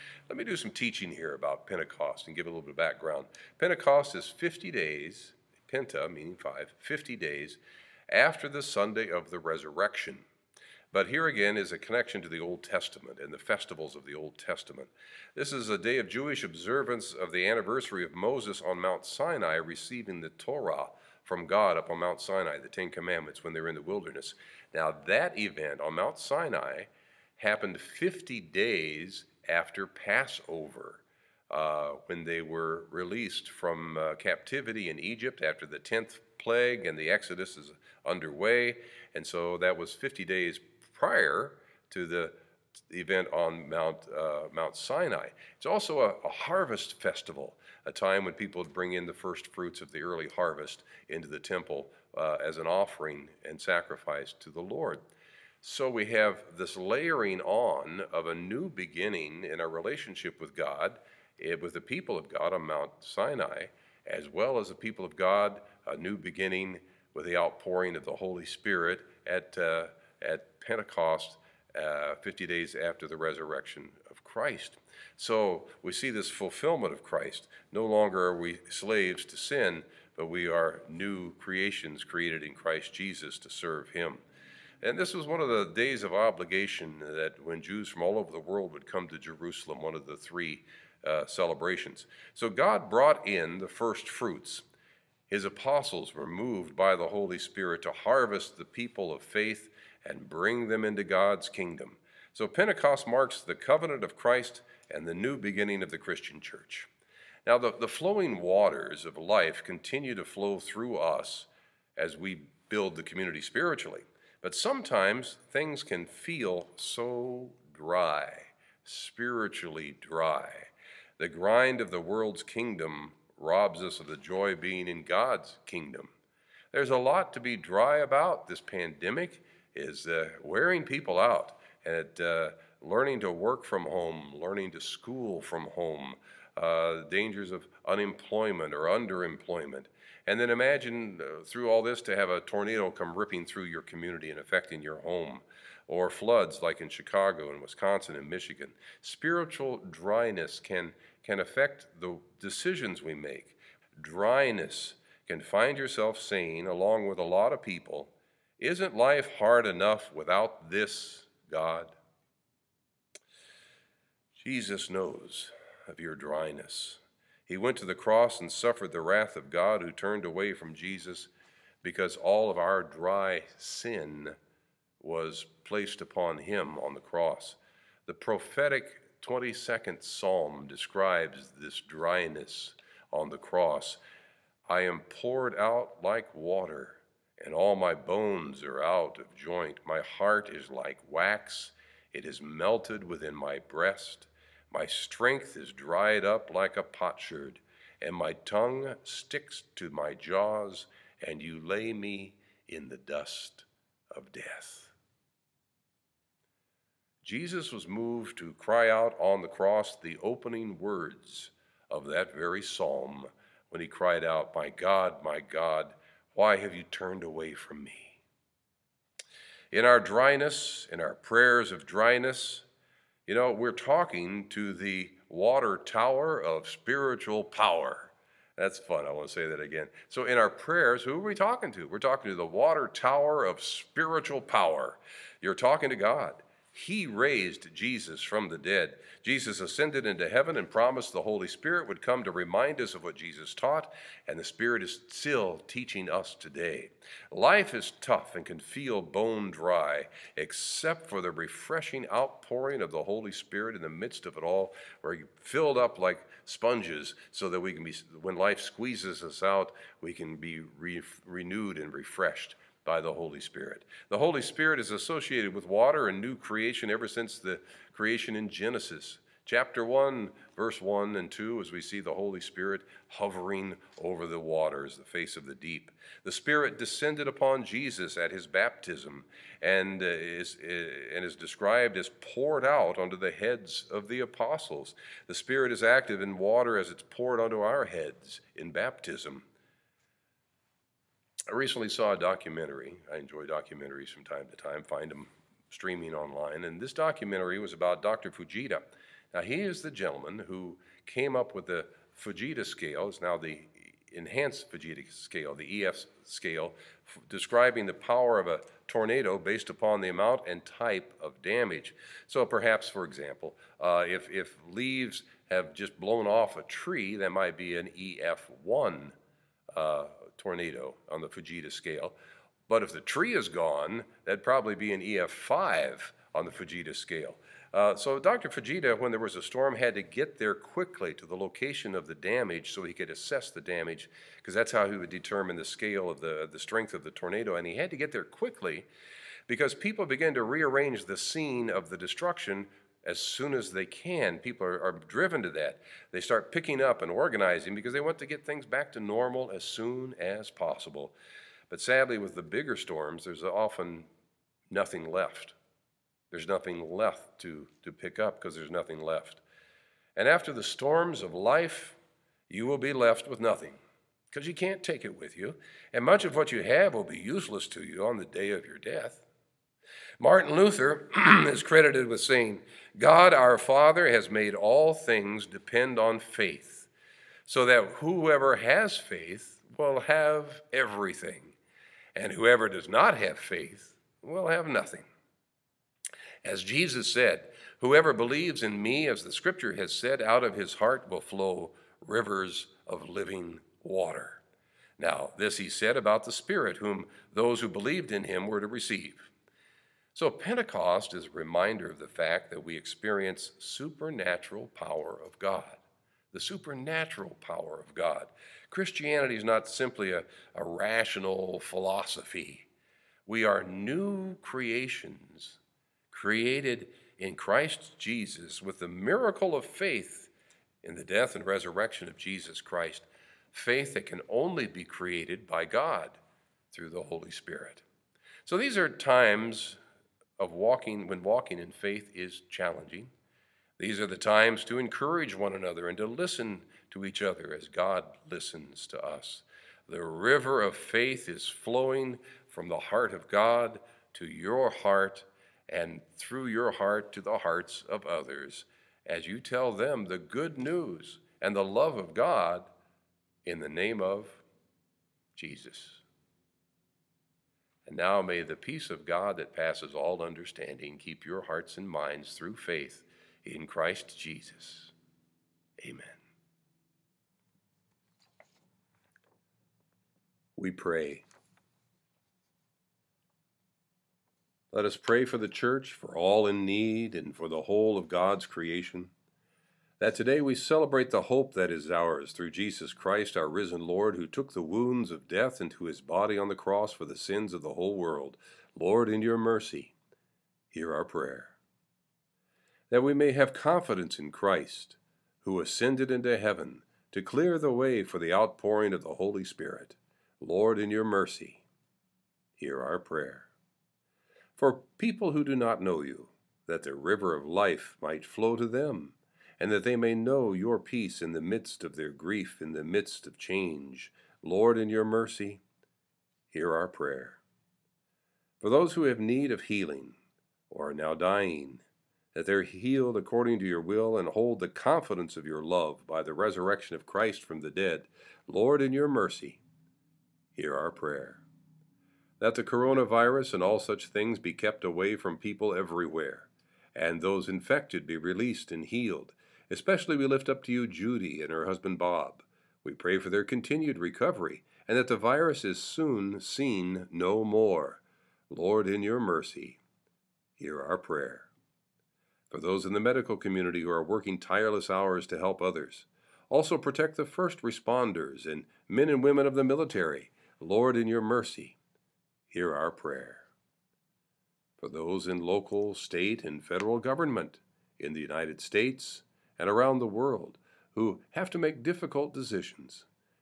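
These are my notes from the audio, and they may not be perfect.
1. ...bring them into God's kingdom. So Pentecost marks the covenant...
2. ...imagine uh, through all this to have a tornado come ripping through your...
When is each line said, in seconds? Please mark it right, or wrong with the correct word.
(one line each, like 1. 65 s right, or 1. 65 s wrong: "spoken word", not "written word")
1. 100 s right
2. 140 s right.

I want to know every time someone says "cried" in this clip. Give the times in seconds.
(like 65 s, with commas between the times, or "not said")
213 s.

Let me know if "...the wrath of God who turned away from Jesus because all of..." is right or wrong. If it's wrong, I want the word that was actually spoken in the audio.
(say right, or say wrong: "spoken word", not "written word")
right.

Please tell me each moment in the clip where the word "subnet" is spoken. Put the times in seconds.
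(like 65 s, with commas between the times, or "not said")
not said.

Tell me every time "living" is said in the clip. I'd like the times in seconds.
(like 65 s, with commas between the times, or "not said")
393 s.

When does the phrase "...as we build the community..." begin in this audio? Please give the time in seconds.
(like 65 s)
111 s.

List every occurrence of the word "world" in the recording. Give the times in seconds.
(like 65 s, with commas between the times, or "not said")
88 s, 121 s, 487 s, 570 s.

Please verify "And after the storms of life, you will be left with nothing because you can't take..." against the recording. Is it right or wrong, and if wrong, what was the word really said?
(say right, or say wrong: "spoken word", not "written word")
right.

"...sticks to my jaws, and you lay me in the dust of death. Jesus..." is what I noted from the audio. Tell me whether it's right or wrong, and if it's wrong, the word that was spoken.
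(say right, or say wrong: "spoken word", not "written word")
right.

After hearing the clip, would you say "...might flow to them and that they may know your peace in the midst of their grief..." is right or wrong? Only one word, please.
right.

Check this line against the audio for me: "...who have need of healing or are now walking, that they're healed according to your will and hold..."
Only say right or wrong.
wrong.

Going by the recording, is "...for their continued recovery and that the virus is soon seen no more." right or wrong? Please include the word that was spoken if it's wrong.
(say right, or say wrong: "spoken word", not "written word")
right.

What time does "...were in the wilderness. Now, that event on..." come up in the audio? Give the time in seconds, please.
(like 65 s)
23 s.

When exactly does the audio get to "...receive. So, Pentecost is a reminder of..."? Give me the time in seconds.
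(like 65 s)
398 s.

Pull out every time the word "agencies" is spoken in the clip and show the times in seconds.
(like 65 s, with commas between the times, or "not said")
not said.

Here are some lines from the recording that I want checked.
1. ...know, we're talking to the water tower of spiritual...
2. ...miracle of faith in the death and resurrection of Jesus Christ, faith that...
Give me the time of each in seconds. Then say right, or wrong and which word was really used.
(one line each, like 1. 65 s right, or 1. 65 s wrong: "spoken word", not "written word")
1. 223 s right
2. 418 s right.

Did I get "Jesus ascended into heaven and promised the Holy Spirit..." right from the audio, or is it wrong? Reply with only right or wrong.
right.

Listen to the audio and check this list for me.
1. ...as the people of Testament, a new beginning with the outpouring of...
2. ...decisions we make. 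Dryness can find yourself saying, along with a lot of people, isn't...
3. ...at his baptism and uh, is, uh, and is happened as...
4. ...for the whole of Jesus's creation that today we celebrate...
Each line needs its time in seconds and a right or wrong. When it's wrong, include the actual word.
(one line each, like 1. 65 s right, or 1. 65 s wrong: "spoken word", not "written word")
1. 64 s wrong: "God", not "Testament"
2. 152 s right
3. 278 s wrong: "described", not "happened"
4. 477 s wrong: "God", not "Jesus".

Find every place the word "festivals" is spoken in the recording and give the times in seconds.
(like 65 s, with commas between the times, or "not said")
13 s, 47 s.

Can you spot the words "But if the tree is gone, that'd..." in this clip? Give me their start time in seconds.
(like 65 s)
322 s.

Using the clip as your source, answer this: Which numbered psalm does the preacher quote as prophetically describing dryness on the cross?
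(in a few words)
22nd.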